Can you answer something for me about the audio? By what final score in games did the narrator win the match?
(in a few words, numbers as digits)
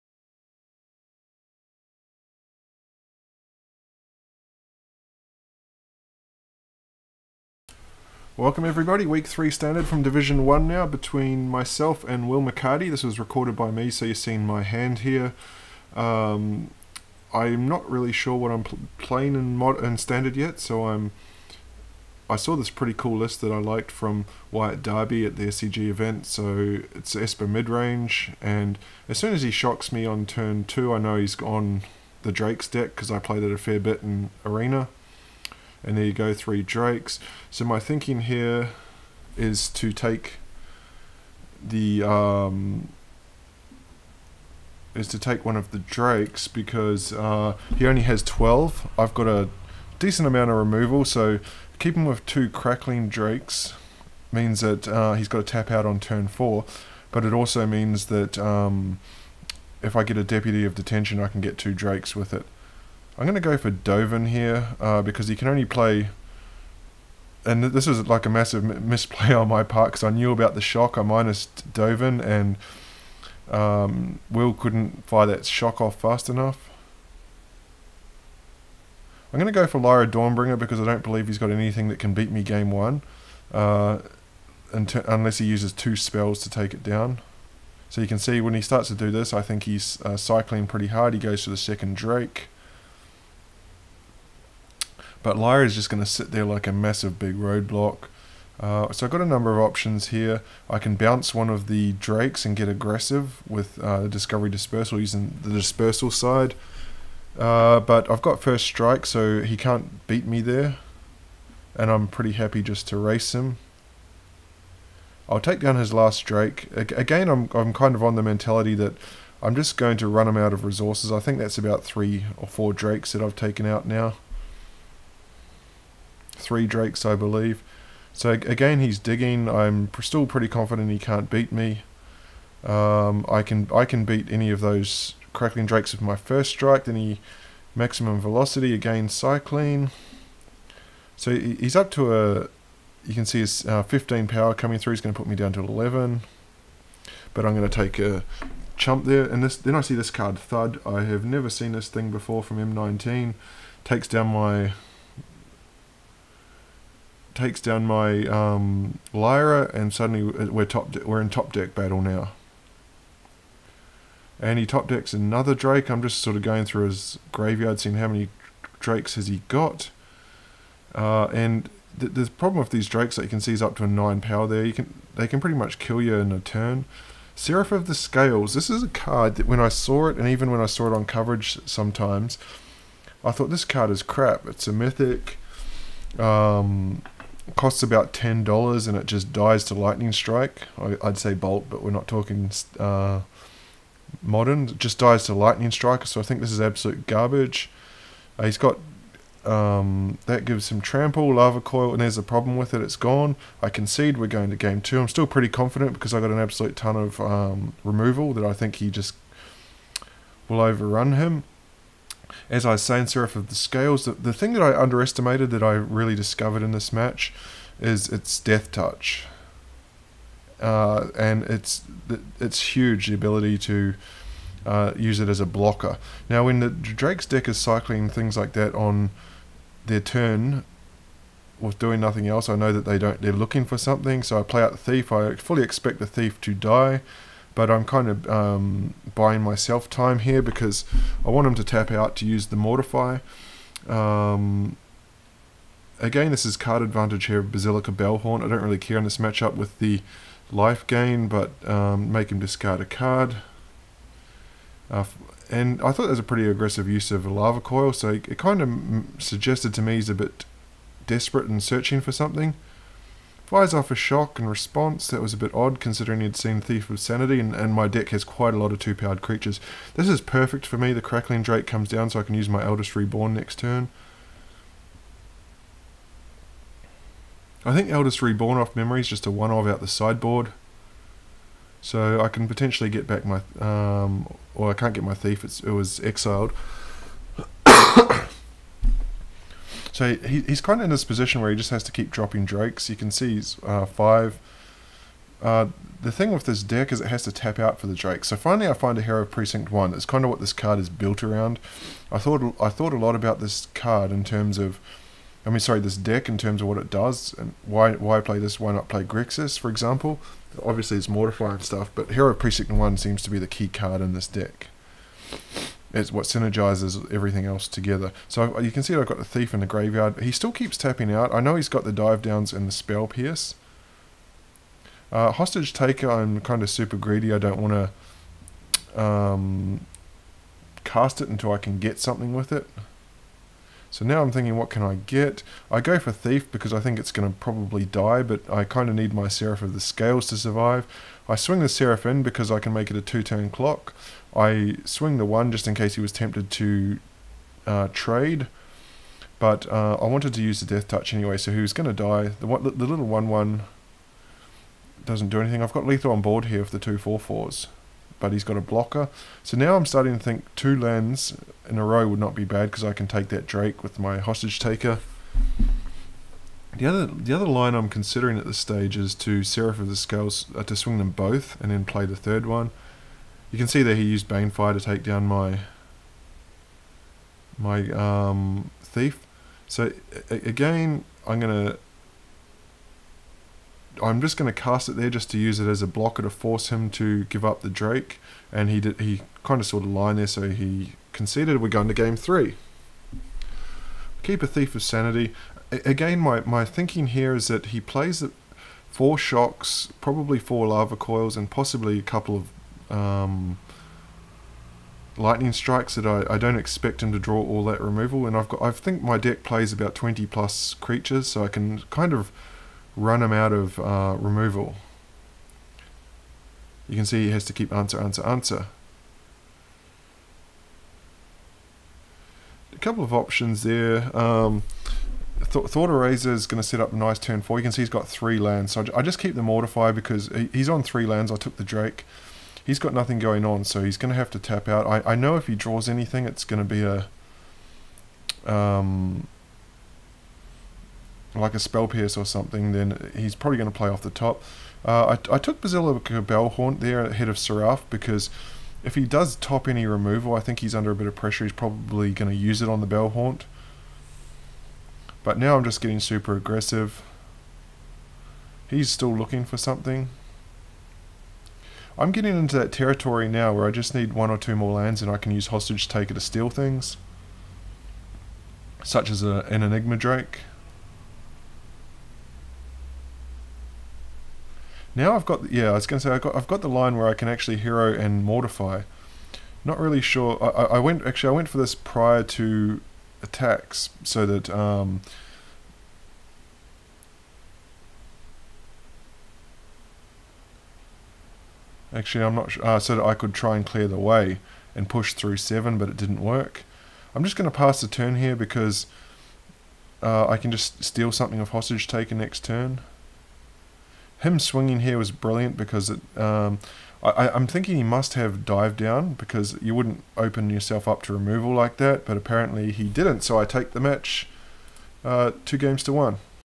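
2 games to 1.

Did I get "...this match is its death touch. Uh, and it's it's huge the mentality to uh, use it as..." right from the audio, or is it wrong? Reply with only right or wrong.
wrong.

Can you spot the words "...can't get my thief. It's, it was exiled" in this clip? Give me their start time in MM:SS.
04:44.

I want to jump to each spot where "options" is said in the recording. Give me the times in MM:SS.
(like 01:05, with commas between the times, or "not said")
01:39, 07:03.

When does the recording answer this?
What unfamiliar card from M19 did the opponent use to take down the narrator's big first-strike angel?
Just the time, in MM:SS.
02:30.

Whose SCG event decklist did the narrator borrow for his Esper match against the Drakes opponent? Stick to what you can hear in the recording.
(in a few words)
Wyatt Darby.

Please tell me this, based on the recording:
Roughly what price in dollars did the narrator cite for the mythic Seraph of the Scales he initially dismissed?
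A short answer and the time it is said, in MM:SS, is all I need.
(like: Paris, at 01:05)
$10, at 03:08.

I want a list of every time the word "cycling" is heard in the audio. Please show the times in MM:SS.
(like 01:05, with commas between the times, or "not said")
01:30, 02:19, 03:47.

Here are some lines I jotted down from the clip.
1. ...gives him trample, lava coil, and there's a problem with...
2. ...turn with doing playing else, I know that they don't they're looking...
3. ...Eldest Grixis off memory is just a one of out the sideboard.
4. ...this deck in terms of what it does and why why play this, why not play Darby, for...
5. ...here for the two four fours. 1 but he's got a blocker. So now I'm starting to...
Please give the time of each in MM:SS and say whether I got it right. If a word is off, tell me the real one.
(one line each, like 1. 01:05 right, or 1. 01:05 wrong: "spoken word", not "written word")
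1. 03:20 right
2. 03:49 wrong: "nothing", not "playing"
3. 04:37 wrong: "Reborn", not "Grixis"
4. 05:05 wrong: "Grixis", not "Darby"
5. 05:56 wrong: "4", not "1".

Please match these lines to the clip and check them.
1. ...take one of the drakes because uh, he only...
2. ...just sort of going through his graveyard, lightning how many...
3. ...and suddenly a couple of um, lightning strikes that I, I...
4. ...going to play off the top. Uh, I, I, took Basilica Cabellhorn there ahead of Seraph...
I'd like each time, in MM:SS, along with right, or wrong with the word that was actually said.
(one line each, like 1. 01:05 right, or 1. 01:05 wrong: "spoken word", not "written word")
1. 00:45 right
2. 02:46 wrong: "seeing", not "lightning"
3. 06:41 wrong: "possibly", not "suddenly"
4. 07:23 right.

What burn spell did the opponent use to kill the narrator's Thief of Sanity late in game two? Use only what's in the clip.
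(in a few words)
Banefire.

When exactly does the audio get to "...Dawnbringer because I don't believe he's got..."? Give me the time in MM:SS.
01:20.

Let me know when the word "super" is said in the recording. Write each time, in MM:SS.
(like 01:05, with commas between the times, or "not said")
05:26, 07:35.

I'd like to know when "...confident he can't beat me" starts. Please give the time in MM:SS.
02:10.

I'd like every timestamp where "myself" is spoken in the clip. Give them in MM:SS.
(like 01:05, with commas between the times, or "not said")
00:11, 03:59.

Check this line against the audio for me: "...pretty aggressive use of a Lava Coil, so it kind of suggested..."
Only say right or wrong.
right.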